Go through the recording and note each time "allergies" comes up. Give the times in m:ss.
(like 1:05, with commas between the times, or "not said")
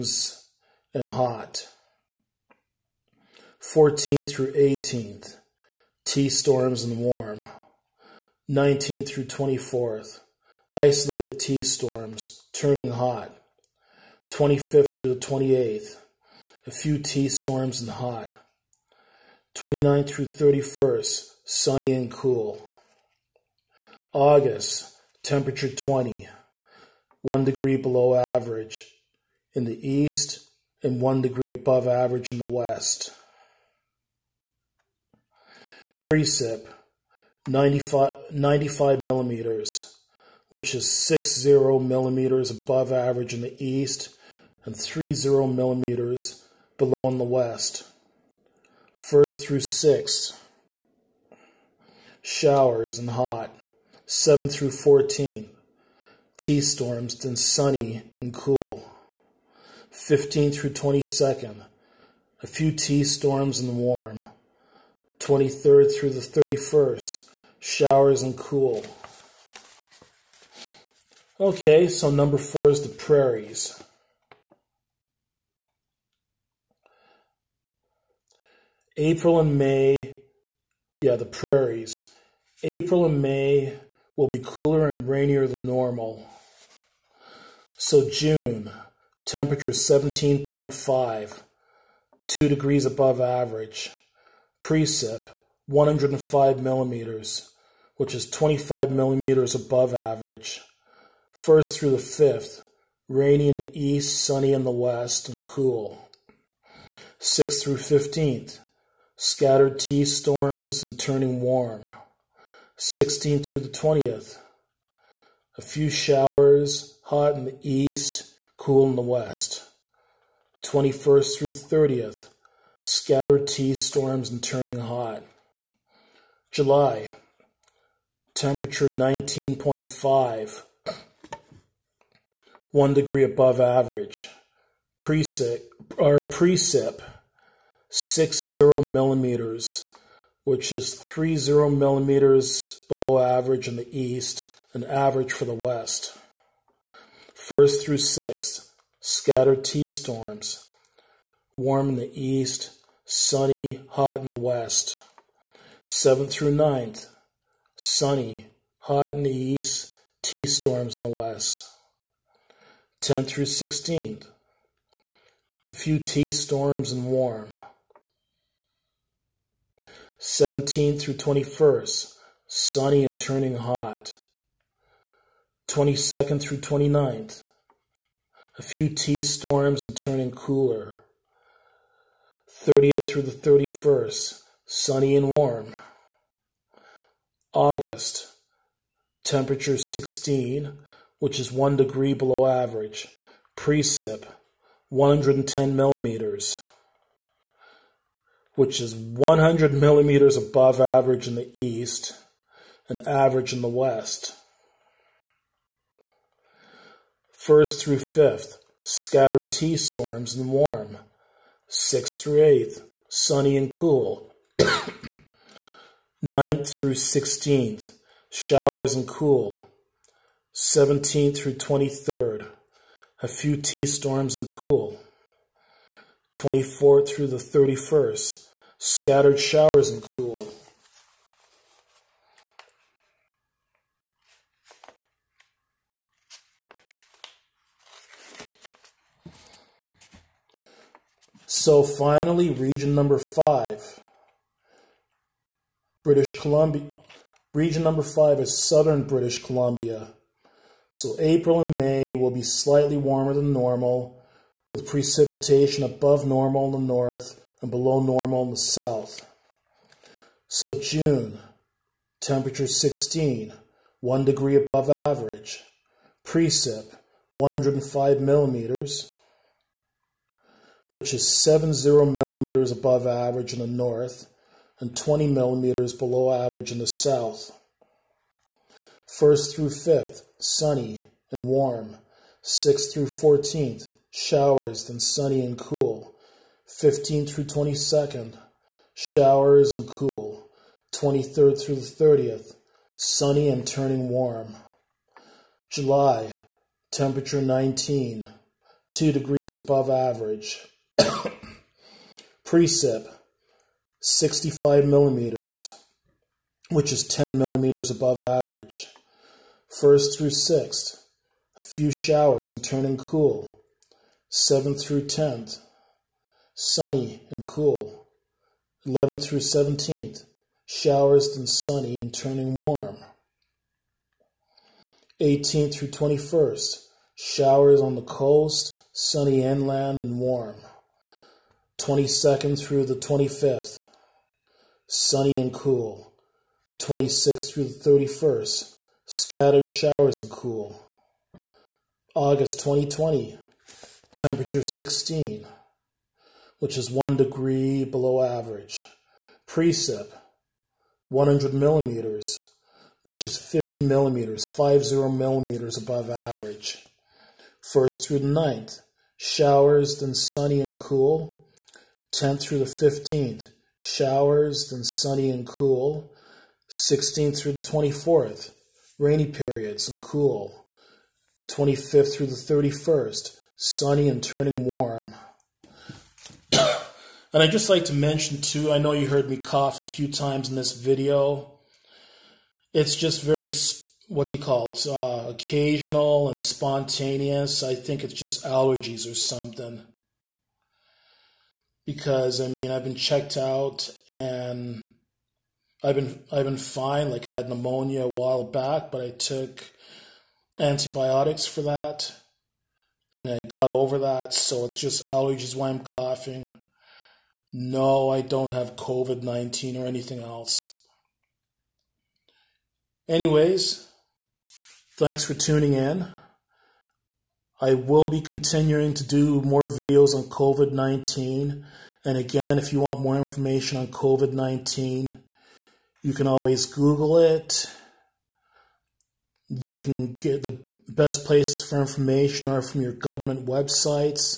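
6:28, 6:45.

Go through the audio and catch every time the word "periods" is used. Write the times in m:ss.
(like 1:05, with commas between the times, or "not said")
6:09.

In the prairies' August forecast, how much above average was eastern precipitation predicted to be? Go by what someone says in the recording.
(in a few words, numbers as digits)
100 millimeters.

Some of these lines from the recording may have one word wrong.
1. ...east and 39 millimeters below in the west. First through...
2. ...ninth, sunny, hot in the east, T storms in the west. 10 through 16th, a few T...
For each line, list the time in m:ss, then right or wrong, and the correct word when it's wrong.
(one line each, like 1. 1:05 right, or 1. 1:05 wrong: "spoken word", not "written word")
1. 0:43 wrong: "30", not "39"
2. 2:36 right.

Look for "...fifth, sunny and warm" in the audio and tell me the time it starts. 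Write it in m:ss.
4:39.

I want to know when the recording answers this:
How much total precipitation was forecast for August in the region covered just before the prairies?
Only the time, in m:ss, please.
0:38.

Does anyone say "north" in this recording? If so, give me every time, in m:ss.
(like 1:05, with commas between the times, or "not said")
4:16, 4:33.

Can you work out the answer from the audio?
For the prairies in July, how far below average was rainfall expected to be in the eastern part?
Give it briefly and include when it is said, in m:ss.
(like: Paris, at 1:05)
30 millimeters, at 2:20.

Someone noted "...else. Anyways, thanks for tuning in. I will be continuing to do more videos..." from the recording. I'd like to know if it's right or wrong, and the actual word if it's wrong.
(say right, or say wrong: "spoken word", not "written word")
right.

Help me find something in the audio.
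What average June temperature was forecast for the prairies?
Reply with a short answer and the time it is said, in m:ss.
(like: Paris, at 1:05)
17.5, at 1:29.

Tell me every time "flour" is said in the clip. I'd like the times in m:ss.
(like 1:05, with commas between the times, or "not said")
not said.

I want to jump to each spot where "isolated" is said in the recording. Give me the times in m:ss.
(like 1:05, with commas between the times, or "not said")
0:10.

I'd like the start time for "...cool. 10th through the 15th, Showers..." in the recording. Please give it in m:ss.
6:00.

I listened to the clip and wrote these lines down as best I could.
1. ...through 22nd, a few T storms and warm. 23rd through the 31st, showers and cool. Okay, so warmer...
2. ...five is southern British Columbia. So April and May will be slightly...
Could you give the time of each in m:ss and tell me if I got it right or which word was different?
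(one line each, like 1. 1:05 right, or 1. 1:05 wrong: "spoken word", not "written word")
1. 1:00 wrong: "number", not "warmer"
2. 4:08 right.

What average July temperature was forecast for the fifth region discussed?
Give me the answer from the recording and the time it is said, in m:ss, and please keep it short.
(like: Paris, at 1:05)
19, at 4:56.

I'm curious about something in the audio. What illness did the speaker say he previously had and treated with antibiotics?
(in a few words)
pneumonia.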